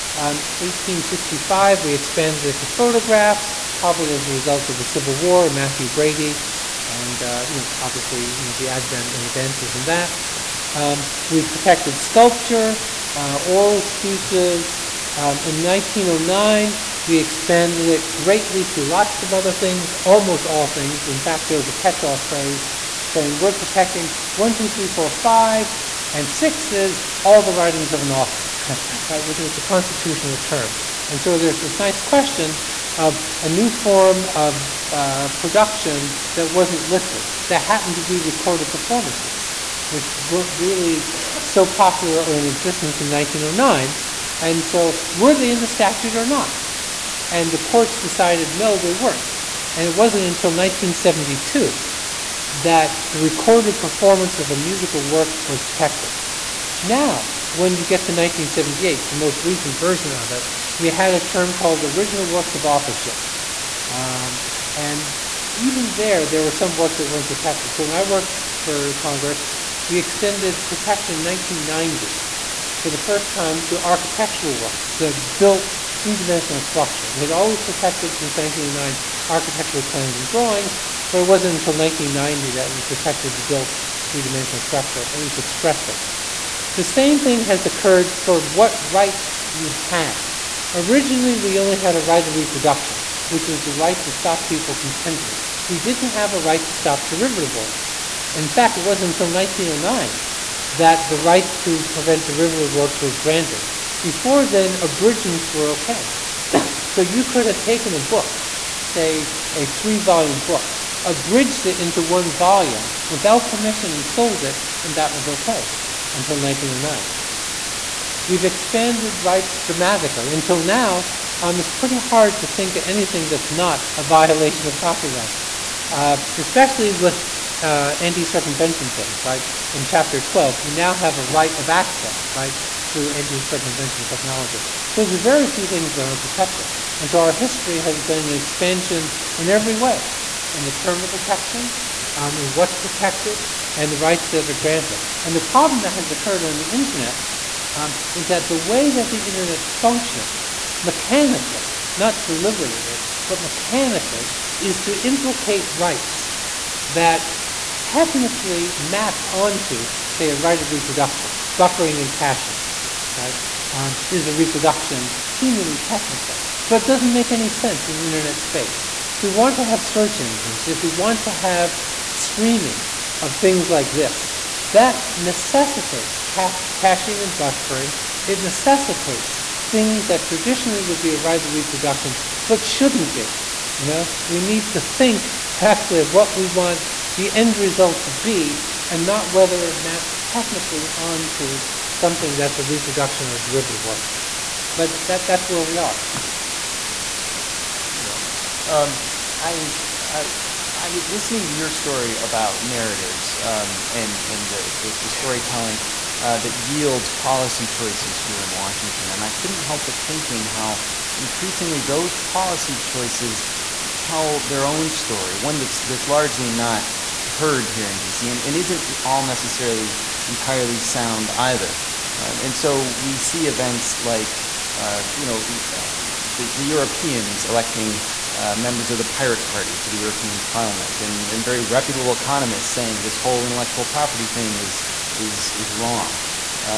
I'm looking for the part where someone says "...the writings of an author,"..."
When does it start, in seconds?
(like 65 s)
27 s.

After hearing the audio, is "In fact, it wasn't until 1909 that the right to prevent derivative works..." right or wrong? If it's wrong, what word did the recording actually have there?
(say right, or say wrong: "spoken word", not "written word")
right.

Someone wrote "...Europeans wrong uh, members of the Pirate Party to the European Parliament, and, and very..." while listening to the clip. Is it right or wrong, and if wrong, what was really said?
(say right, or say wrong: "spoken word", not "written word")
wrong: "electing", not "wrong".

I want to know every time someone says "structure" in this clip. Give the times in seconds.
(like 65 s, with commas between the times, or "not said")
76 s, 84 s.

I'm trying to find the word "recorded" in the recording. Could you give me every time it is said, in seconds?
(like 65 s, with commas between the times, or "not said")
38 s, 53 s.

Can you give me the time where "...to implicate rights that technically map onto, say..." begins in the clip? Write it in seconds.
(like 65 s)
154 s.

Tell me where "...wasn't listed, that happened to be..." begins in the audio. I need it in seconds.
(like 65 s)
36 s.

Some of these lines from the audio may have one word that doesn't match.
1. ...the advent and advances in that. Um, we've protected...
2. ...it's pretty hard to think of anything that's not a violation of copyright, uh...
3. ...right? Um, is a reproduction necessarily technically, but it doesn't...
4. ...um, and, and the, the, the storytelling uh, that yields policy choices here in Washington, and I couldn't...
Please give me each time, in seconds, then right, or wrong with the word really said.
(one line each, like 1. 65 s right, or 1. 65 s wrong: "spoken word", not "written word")
1. 8 s right
2. 121 s right
3. 163 s wrong: "seemingly", not "necessarily"
4. 203 s right.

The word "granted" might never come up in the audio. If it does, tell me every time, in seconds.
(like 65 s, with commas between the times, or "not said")
103 s, 144 s.